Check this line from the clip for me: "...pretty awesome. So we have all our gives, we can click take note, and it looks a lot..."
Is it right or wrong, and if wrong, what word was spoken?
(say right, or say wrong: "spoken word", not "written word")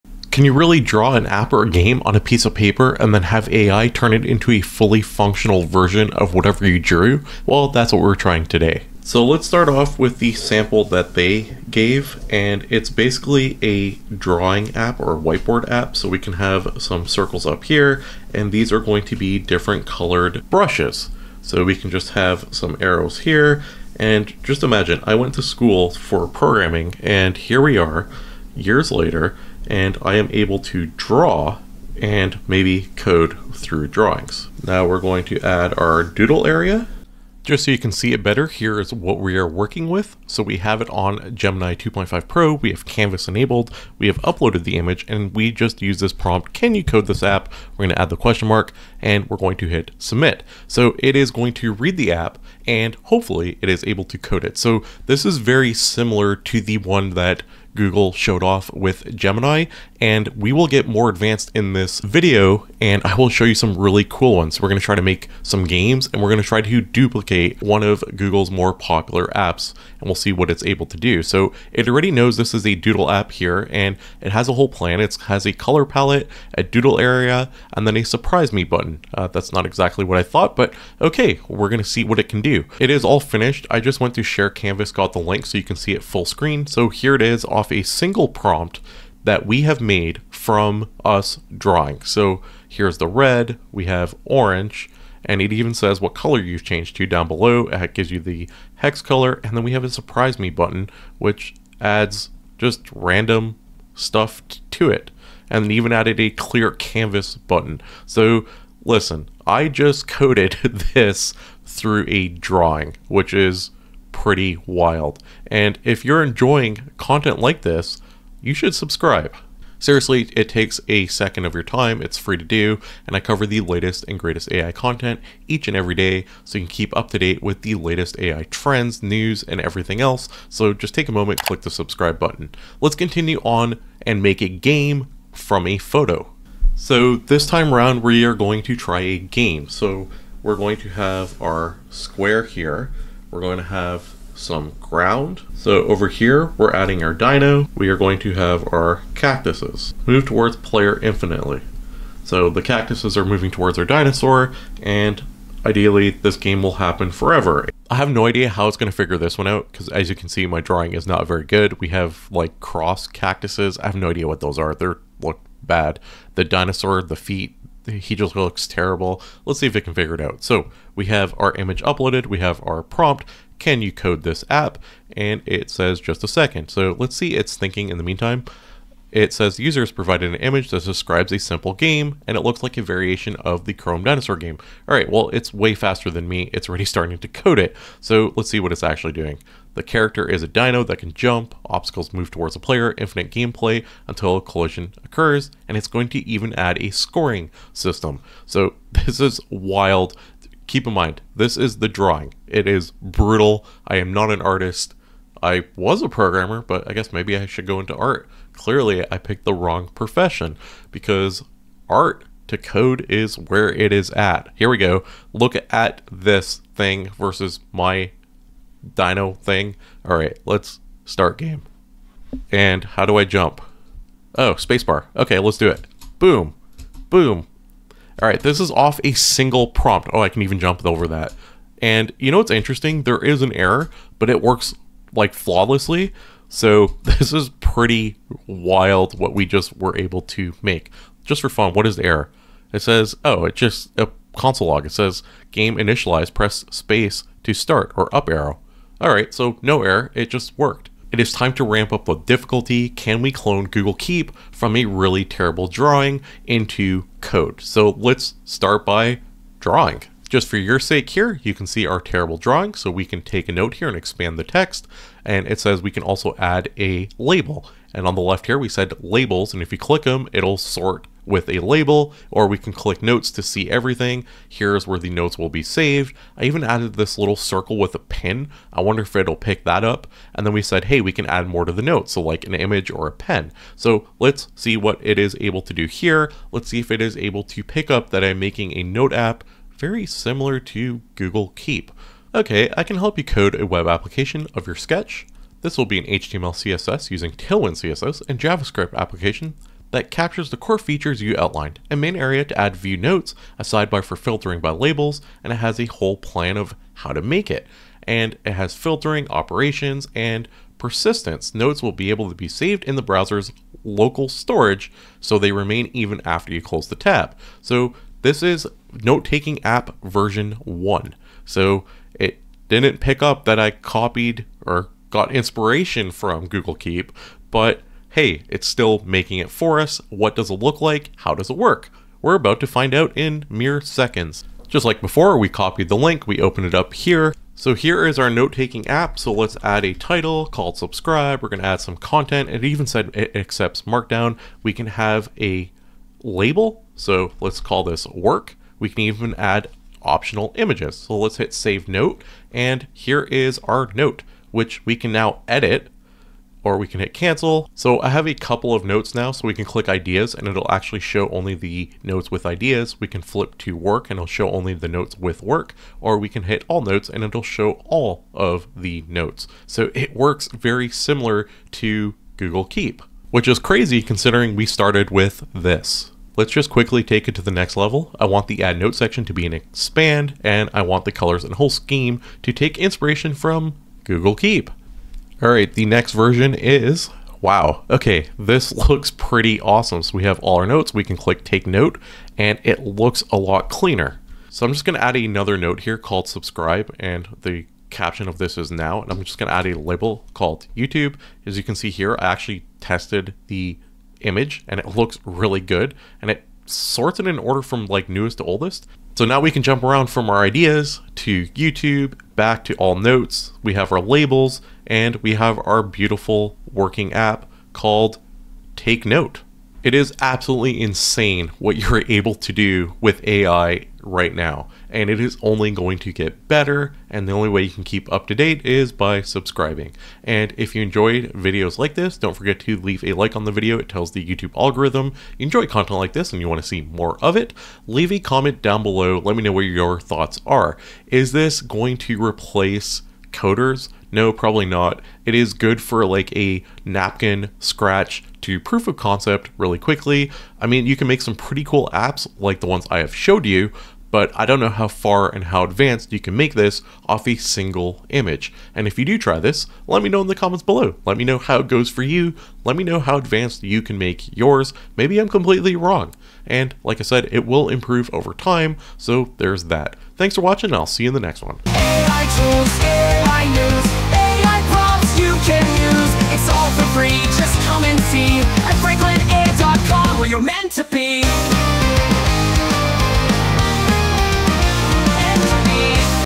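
wrong: "notes", not "gives".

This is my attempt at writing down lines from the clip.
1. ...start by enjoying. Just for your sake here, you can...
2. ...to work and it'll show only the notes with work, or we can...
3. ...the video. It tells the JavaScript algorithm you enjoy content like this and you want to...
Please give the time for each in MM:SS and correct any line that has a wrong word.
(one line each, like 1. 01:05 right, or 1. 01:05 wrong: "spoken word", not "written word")
1. 04:18 wrong: "drawing", not "enjoying"
2. 06:03 right
3. 07:13 wrong: "YouTube", not "JavaScript".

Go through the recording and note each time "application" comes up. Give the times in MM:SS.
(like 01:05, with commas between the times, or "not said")
04:53, 04:58.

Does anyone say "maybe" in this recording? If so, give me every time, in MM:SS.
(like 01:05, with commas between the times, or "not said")
00:32, 03:27, 07:44.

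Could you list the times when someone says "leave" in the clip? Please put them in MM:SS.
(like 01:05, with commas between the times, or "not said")
07:12, 07:17.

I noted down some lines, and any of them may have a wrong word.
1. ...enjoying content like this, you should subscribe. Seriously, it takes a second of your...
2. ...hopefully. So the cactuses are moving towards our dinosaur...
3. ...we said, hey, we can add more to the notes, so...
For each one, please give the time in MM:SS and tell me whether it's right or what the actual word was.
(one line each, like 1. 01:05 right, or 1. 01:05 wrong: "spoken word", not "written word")
1. 01:56 right
2. 02:31 wrong: "infinitely", not "hopefully"
3. 04:40 right.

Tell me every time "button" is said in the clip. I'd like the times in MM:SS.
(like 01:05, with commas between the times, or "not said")
01:18, 01:40, 01:47, 02:12.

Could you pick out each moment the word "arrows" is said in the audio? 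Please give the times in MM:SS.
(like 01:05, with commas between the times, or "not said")
00:22, 04:08.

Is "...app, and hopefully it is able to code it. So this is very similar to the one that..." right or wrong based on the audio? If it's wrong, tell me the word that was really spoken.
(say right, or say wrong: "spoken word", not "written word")
right.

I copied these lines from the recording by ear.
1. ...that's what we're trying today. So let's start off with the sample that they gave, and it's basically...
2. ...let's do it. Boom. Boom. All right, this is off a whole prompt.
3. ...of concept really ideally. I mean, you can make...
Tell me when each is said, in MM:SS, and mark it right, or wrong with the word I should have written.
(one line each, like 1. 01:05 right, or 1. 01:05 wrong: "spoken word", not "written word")
1. 00:07 right
2. 03:45 wrong: "single", not "whole"
3. 07:28 wrong: "quickly", not "ideally".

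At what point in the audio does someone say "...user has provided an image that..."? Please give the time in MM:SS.
02:59.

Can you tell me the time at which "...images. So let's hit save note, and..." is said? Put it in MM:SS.
05:50.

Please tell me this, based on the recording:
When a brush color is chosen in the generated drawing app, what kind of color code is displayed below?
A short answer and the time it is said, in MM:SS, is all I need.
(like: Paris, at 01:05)
Hex color, at 01:38.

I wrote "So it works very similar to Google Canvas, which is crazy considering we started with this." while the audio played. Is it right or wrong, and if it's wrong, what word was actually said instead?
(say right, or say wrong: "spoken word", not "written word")
wrong: "Keep", not "Canvas".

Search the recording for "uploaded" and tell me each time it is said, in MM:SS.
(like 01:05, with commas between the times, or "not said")
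00:44, 02:51.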